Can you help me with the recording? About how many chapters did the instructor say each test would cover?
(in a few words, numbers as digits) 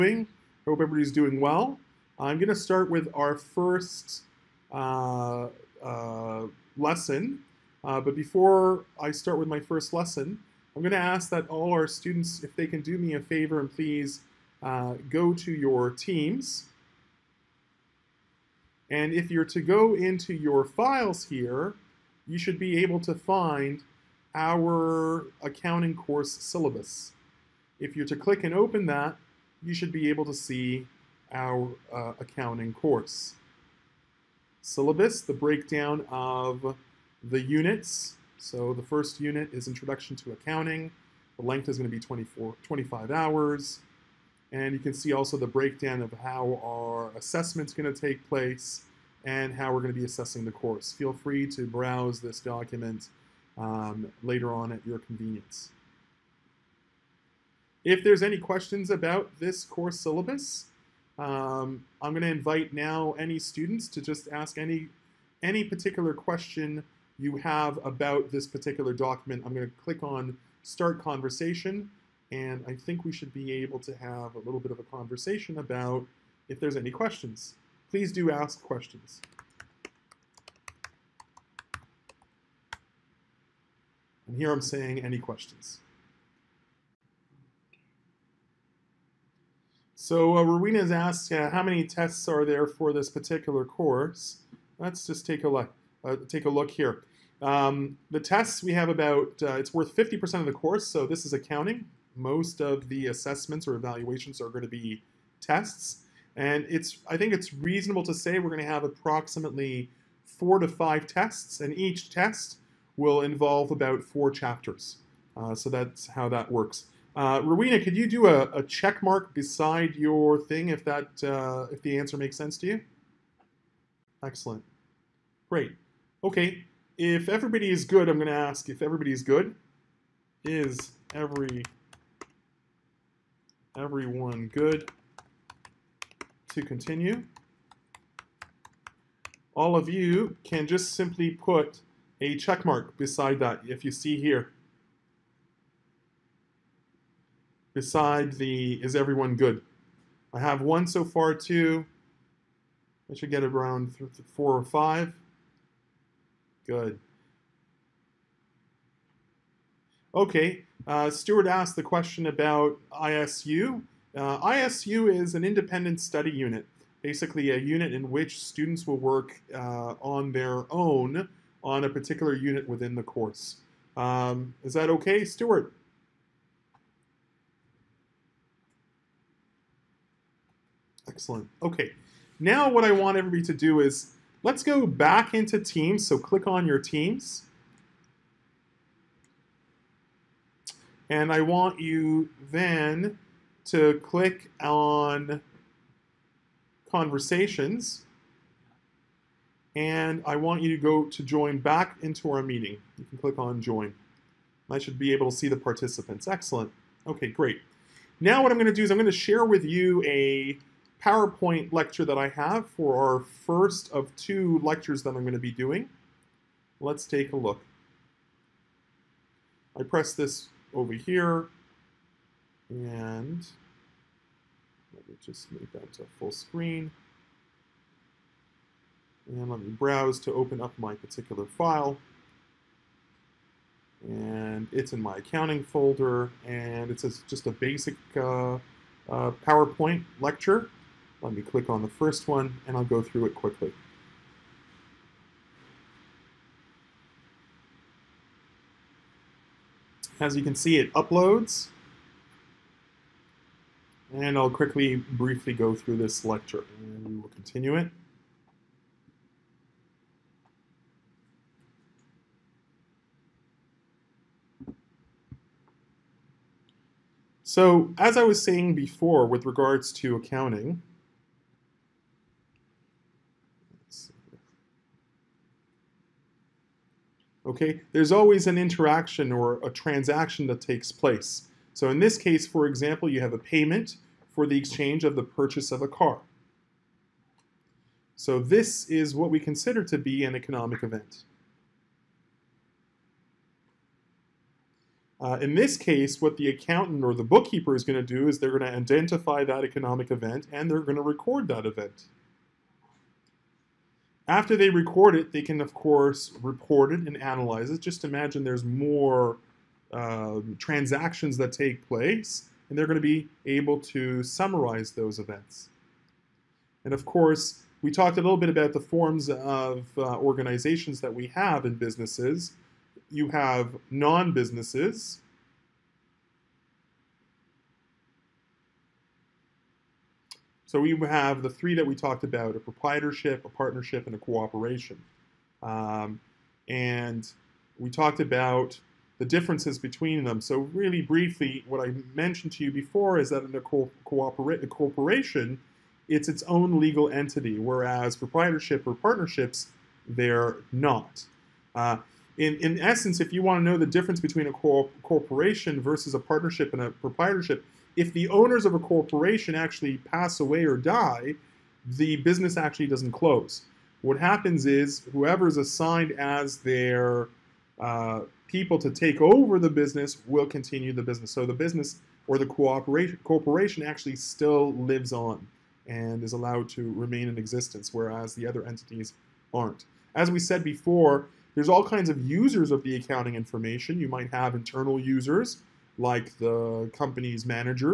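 4.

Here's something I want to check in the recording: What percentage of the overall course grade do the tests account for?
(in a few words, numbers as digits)
50%.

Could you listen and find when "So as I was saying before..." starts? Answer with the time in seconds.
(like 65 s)
267 s.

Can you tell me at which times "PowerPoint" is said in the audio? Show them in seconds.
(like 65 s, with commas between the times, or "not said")
211 s, 239 s.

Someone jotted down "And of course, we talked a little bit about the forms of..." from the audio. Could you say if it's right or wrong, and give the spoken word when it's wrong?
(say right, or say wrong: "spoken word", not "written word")
right.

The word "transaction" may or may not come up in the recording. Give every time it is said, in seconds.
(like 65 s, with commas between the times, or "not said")
279 s, 310 s.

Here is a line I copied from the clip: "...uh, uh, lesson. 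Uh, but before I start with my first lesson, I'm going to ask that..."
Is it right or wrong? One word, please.
right.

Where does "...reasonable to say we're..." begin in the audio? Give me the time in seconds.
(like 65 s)
107 s.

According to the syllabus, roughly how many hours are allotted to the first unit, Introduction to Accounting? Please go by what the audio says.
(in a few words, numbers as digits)
24-25 hours.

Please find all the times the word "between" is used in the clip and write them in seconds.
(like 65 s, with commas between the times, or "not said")
339 s, 354 s.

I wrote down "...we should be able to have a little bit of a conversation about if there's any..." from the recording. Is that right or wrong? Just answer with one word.
right.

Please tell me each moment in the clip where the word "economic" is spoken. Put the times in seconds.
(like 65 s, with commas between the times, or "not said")
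290 s, 299 s.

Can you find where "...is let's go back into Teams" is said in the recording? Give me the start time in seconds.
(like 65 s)
183 s.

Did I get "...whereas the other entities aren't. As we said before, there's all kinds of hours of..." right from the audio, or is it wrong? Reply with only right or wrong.
wrong.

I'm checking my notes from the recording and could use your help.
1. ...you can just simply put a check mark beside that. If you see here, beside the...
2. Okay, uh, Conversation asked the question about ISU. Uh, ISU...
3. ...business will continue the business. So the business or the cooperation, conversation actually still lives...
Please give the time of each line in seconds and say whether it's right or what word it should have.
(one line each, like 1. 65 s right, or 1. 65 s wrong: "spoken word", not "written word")
1. 139 s right
2. 160 s wrong: "Stuart", not "Conversation"
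3. 369 s wrong: "corporation", not "conversation".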